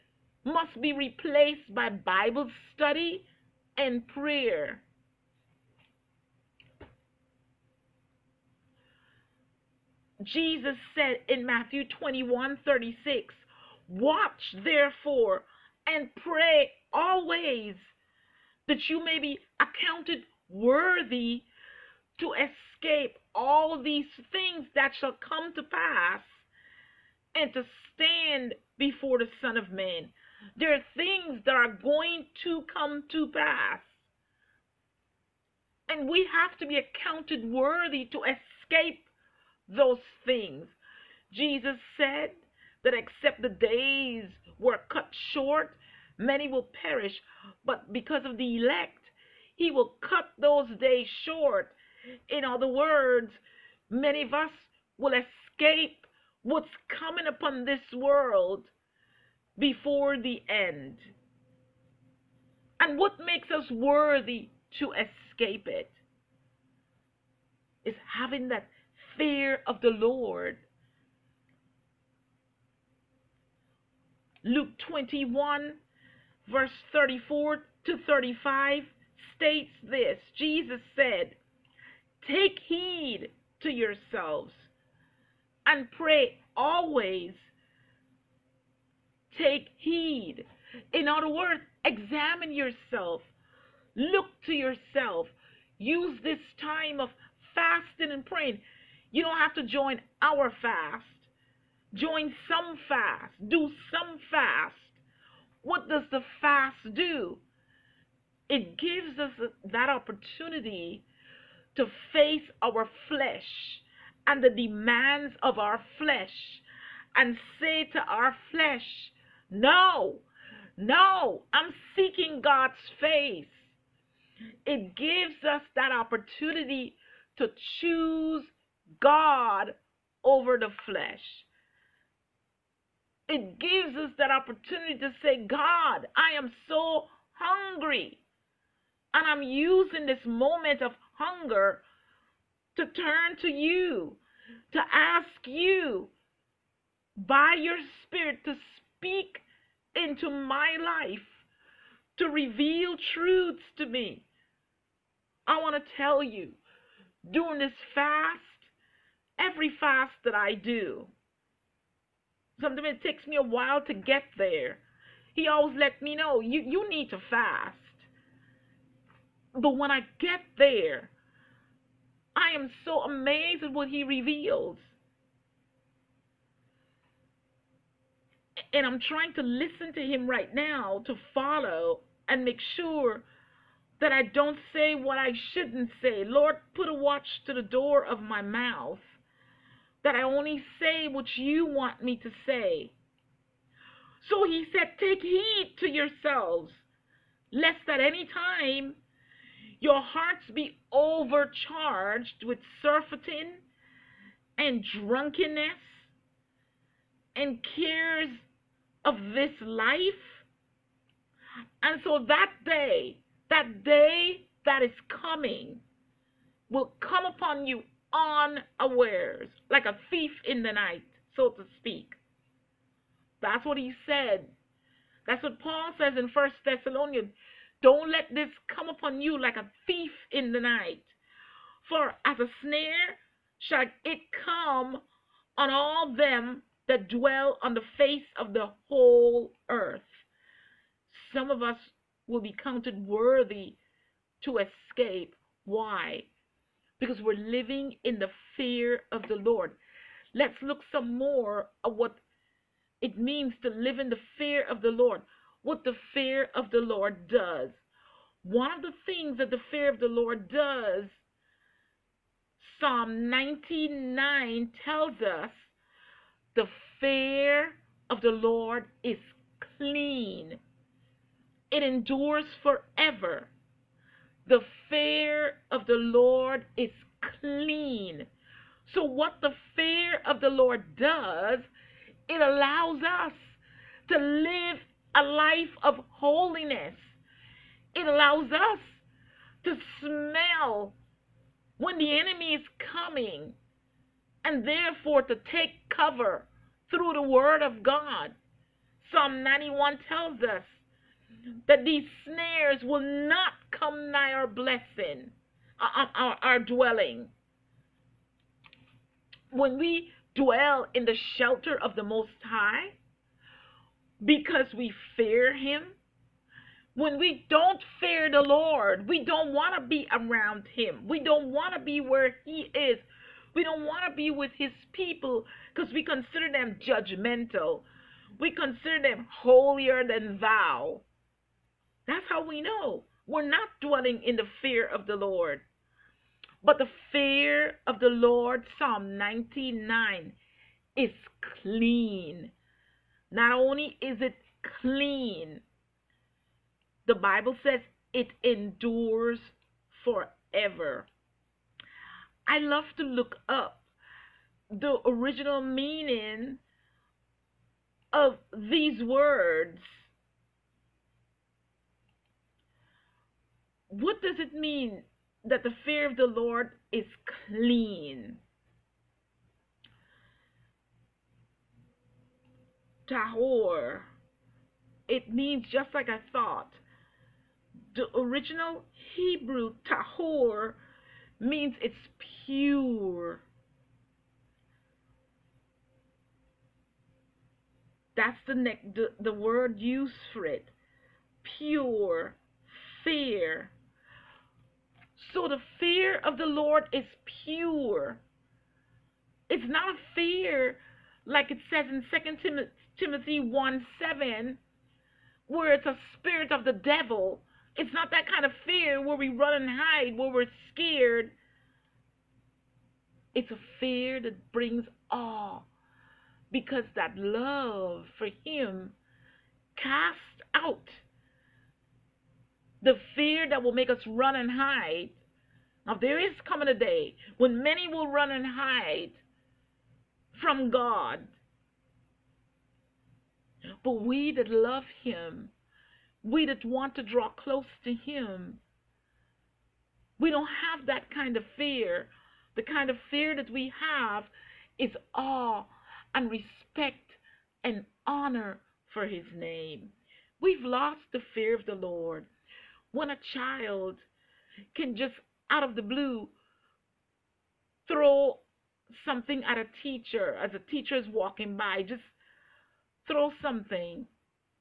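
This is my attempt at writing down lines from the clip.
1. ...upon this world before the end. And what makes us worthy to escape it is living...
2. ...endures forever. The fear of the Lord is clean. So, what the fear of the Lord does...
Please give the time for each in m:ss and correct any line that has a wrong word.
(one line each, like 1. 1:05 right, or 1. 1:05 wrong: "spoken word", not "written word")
1. 0:57 wrong: "having", not "living"
2. 4:31 right.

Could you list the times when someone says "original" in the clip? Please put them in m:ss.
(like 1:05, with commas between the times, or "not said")
5:55, 6:18.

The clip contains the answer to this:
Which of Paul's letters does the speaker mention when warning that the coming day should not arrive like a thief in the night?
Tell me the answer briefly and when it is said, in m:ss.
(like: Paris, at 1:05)
First Thessalonians, at 3:46.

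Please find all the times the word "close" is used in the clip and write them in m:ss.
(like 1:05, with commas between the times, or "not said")
7:17.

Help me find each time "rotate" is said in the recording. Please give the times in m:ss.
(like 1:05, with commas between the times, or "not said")
not said.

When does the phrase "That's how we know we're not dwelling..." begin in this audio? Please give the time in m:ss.
5:32.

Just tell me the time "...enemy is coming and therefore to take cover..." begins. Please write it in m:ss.
4:52.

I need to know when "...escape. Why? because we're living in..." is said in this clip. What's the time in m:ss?
4:04.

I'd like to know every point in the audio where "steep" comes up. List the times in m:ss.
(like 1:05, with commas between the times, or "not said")
not said.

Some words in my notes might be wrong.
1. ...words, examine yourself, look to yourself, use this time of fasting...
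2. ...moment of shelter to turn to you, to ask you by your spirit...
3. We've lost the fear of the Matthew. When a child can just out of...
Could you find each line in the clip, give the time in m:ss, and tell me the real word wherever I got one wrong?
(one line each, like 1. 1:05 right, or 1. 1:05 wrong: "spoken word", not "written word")
1. 1:31 right
2. 2:20 wrong: "hunger", not "shelter"
3. 7:30 wrong: "Lord", not "Matthew".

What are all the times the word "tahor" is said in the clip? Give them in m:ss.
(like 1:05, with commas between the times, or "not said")
6:13, 6:19.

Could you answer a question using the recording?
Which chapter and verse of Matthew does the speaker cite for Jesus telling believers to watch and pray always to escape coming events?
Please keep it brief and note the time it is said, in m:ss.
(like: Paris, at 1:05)
21:36, at 0:11.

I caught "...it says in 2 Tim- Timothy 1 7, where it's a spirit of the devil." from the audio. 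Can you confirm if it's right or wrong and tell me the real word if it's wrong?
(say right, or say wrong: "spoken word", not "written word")
right.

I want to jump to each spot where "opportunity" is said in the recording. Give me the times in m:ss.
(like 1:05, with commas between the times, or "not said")
1:49, 2:05, 2:14.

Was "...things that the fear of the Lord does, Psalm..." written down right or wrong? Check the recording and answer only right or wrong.
right.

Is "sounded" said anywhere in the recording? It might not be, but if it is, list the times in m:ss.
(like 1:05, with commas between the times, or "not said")
not said.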